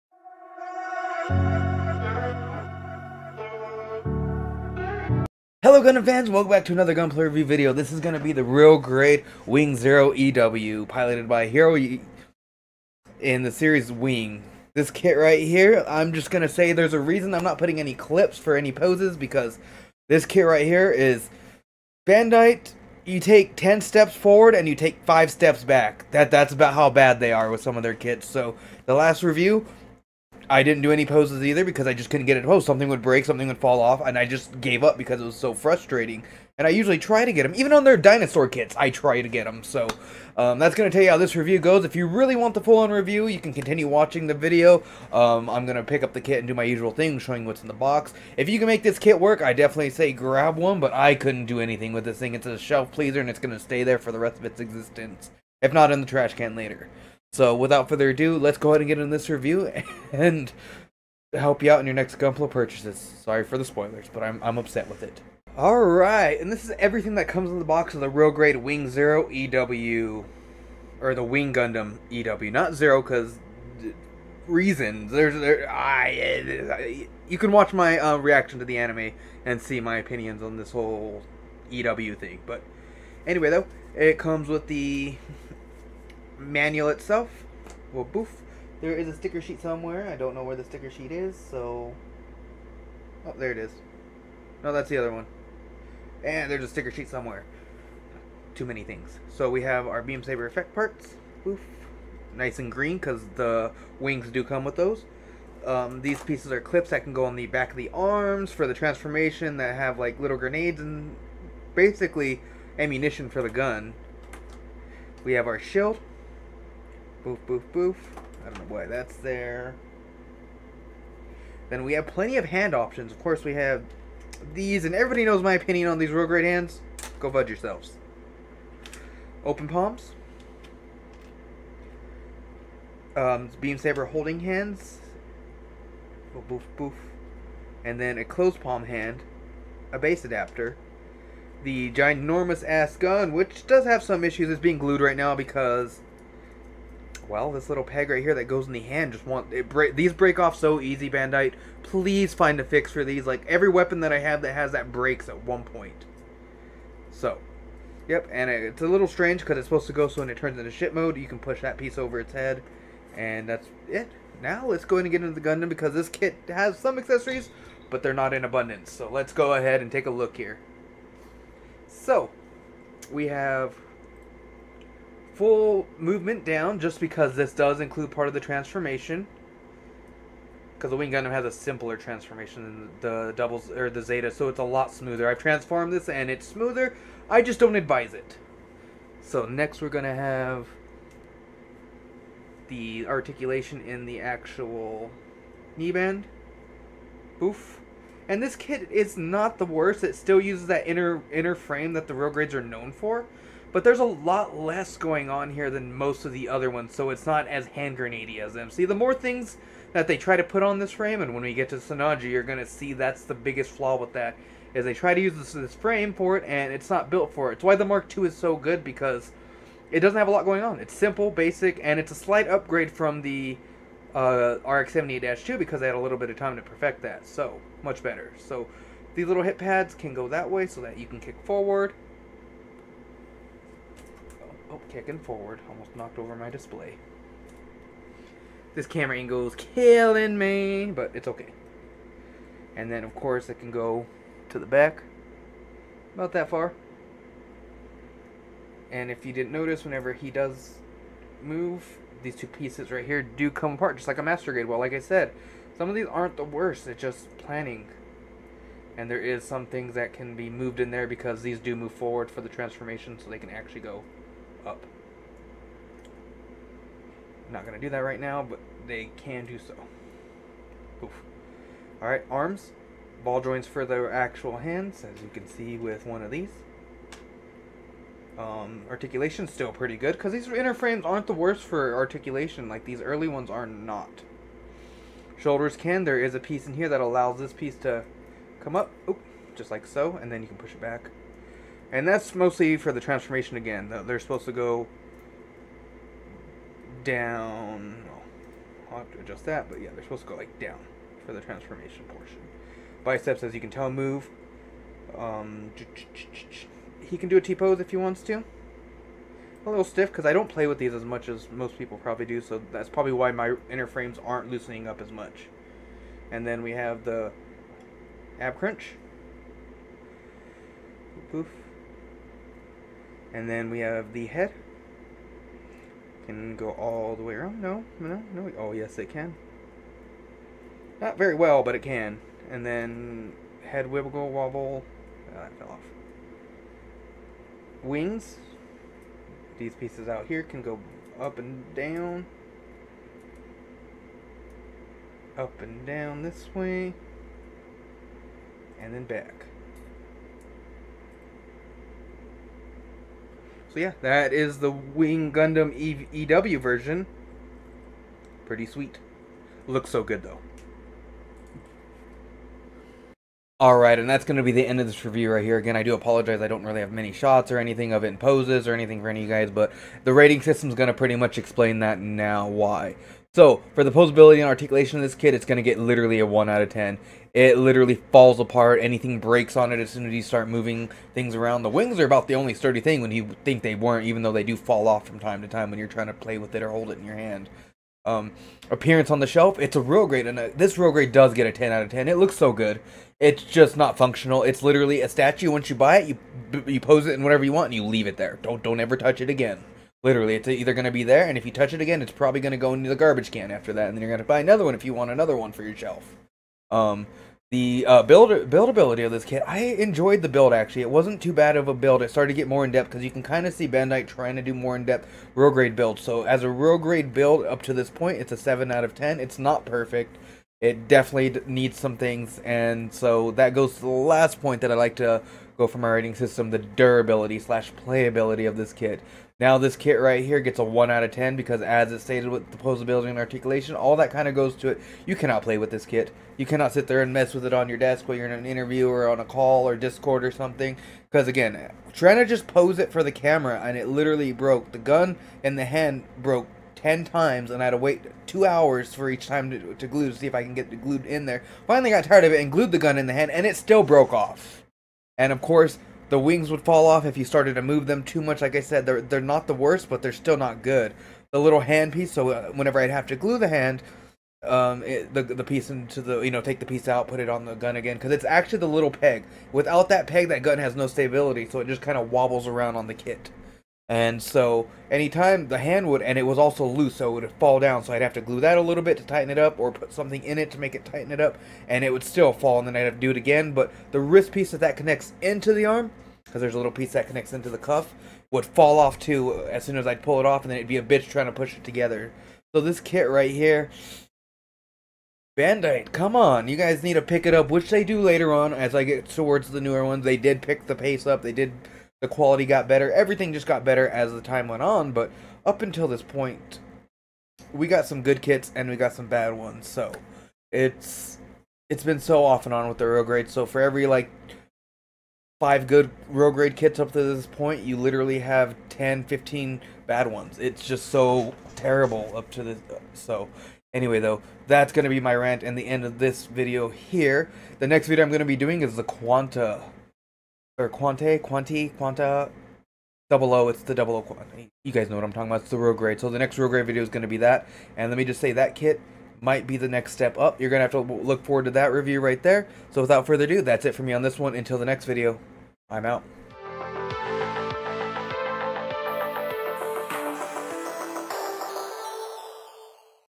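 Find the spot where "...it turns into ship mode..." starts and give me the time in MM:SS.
02:40.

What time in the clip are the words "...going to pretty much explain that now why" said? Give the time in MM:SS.
06:10.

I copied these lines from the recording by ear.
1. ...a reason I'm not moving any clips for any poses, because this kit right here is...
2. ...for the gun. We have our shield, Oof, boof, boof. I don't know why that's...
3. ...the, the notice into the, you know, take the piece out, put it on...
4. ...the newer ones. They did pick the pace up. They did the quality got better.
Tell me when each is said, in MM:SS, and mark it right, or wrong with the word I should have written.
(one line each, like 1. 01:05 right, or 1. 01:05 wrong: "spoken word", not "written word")
1. 00:16 wrong: "putting", not "moving"
2. 01:53 wrong: "Boof", not "Oof"
3. 07:45 wrong: "piece", not "notice"
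4. 08:19 right.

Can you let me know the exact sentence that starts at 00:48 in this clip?
If you can make this kit work, I definitely say grab one, but I couldn't do anything with this thing.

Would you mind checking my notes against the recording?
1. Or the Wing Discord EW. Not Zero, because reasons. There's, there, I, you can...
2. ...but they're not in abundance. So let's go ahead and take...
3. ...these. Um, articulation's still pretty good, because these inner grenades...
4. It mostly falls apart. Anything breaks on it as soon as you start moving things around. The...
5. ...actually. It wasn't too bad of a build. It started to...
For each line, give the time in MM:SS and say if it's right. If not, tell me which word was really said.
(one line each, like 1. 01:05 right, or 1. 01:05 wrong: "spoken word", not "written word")
1. 01:10 wrong: "Gundam", not "Discord"
2. 02:47 right
3. 04:36 wrong: "frames", not "grenades"
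4. 06:17 wrong: "literally", not "mostly"
5. 06:50 right.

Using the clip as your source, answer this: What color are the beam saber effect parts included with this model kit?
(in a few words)
Green.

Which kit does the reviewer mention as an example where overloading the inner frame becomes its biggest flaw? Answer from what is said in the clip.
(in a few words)
Sinanju.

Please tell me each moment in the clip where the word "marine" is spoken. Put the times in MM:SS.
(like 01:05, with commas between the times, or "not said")
not said.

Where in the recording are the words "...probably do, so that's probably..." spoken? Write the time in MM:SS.
05:11.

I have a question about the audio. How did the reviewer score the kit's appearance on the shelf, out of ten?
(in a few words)
10.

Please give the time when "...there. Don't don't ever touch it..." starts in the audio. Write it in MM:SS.
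06:38.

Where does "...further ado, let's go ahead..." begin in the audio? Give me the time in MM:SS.
00:57.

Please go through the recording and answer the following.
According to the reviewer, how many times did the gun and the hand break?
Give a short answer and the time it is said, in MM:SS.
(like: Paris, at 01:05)
10, at 07:26.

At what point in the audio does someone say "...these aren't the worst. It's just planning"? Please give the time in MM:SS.
04:15.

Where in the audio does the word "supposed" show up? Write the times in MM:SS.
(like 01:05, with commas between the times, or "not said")
02:39, 04:54, 05:00.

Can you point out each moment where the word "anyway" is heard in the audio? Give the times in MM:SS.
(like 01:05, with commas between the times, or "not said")
01:23, 08:43.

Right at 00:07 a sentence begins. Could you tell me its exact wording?
This is going to be the real grade Wing Zero EW, piloted by Hero e in the series Wing.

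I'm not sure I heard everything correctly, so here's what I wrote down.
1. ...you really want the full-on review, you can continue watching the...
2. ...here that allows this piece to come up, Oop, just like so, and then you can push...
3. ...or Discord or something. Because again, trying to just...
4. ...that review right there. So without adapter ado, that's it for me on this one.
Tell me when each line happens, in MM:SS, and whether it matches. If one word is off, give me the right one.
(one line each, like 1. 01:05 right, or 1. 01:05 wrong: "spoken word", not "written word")
1. 00:41 right
2. 04:46 right
3. 07:19 right
4. 09:01 wrong: "further", not "adapter".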